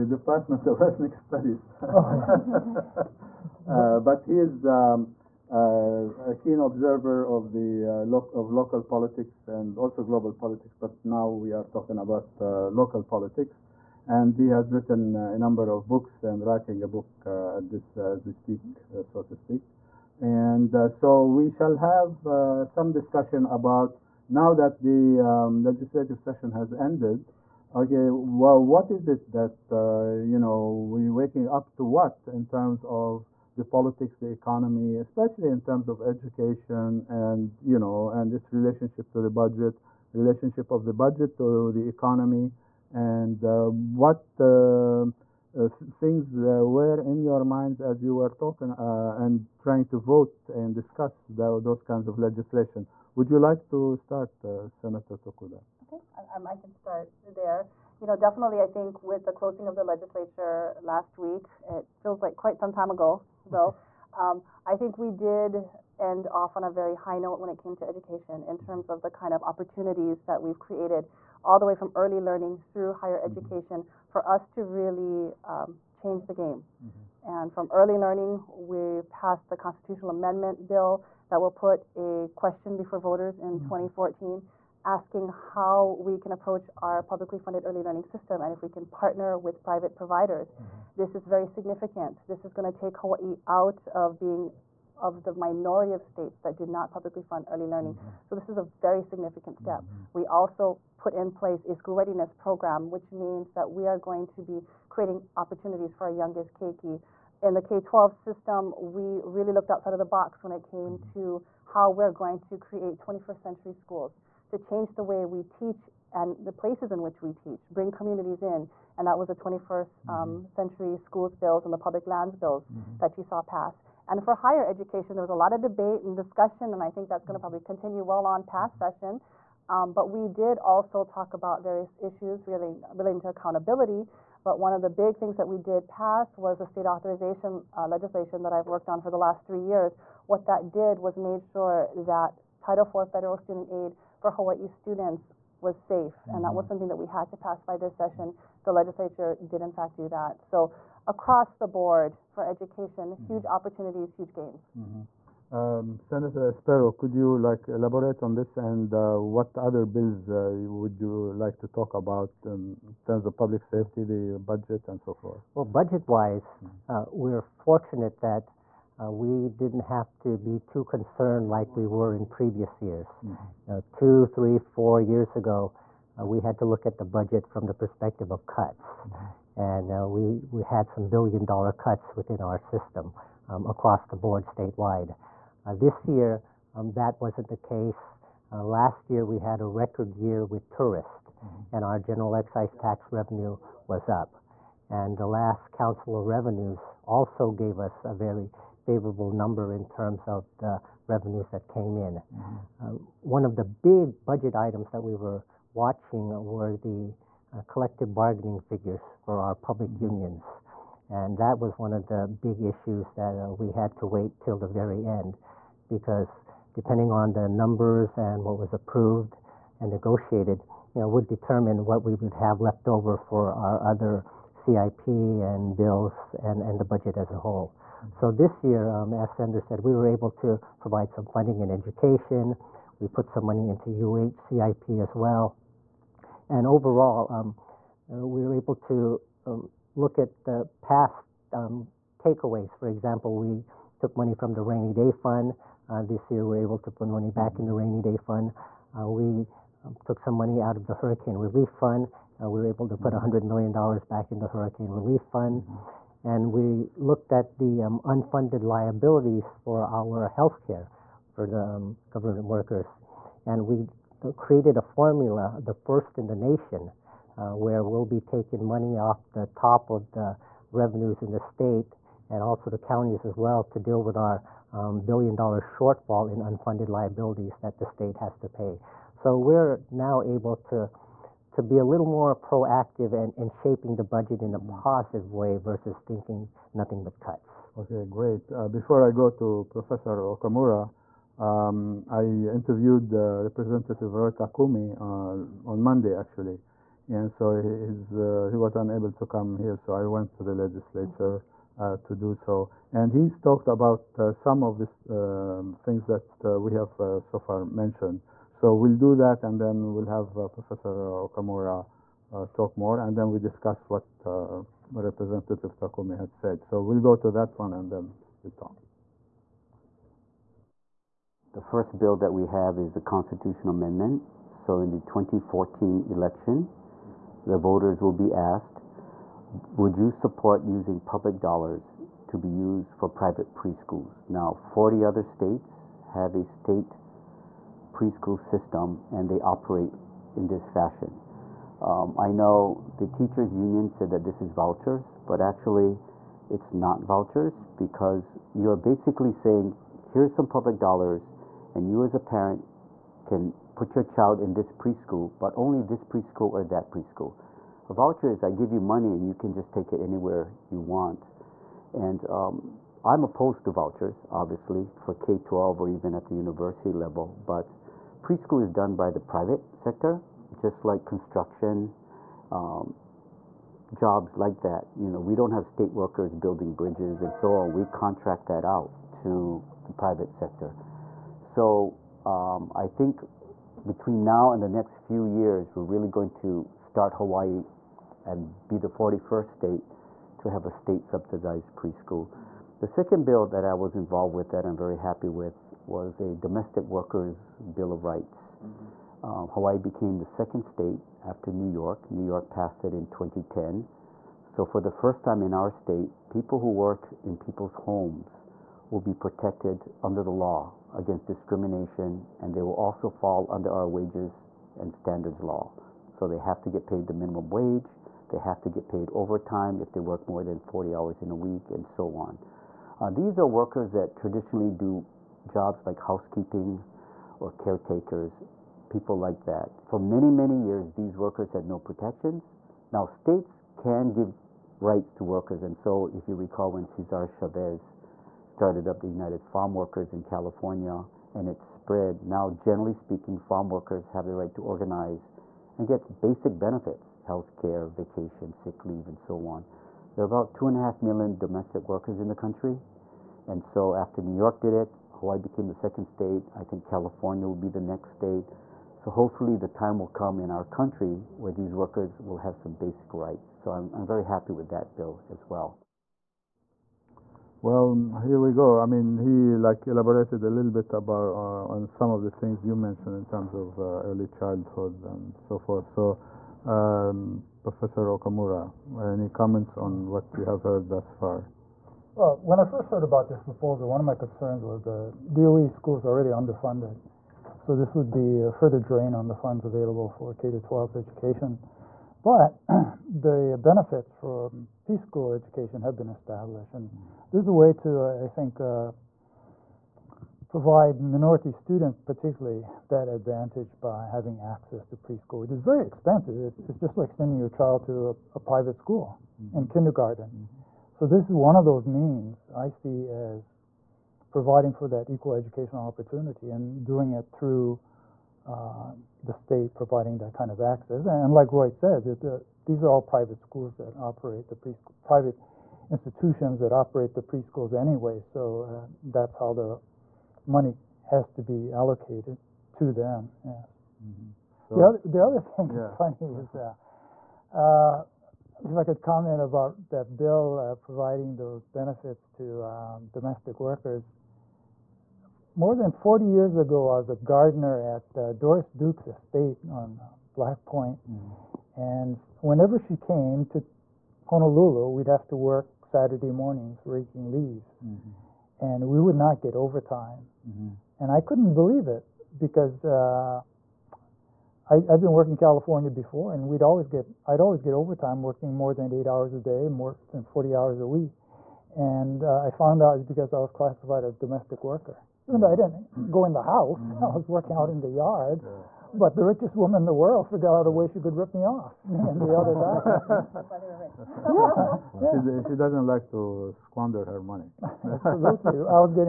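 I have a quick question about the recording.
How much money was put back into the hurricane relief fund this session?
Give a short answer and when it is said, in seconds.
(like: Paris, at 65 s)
$100 million, at 253 s.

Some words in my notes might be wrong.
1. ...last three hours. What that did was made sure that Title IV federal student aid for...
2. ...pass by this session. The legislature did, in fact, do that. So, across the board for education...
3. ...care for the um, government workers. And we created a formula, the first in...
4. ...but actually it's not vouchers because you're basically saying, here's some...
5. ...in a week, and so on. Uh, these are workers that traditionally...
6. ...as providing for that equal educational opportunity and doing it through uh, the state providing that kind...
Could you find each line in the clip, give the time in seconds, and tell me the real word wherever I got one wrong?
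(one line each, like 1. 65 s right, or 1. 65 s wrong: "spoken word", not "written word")
1. 139 s wrong: "years", not "hours"
2. 147 s right
3. 260 s right
4. 345 s right
5. 421 s right
6. 513 s right.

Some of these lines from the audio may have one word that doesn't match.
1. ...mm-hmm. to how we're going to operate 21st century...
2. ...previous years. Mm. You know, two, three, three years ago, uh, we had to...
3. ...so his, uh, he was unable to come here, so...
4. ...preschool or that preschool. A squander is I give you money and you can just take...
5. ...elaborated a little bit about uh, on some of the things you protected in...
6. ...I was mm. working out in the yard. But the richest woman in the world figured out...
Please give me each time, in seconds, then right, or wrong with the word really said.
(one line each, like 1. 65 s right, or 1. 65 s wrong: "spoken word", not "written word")
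1. 110 s wrong: "create", not "operate"
2. 172 s wrong: "four", not "three"
3. 297 s right
4. 356 s wrong: "voucher", not "squander"
5. 469 s wrong: "mentioned", not "protected"
6. 577 s right.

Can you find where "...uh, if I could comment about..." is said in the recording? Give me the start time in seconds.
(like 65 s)
537 s.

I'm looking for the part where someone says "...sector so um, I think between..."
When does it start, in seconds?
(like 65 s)
380 s.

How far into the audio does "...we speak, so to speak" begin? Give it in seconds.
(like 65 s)
18 s.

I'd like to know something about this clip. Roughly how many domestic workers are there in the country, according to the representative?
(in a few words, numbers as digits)
2.5 million.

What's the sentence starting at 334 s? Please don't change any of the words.
Now, 40 other states have a state preschool system and they operate in this fashion.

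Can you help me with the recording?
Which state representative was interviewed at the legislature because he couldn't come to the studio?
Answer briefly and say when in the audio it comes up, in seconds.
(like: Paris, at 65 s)
Roy Takumi, at 294 s.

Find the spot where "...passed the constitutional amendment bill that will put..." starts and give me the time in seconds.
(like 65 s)
79 s.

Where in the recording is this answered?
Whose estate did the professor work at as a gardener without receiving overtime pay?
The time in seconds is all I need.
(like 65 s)
548 s.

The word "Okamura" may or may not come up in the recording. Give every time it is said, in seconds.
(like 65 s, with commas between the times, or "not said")
290 s, 310 s, 478 s.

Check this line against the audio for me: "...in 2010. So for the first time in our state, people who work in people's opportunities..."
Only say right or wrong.
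wrong.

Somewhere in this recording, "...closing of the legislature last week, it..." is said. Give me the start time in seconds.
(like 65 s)
59 s.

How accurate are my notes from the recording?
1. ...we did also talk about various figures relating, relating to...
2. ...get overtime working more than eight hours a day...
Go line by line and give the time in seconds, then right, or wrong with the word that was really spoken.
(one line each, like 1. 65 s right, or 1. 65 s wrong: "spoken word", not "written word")
1. 130 s wrong: "issues", not "figures"
2. 567 s right.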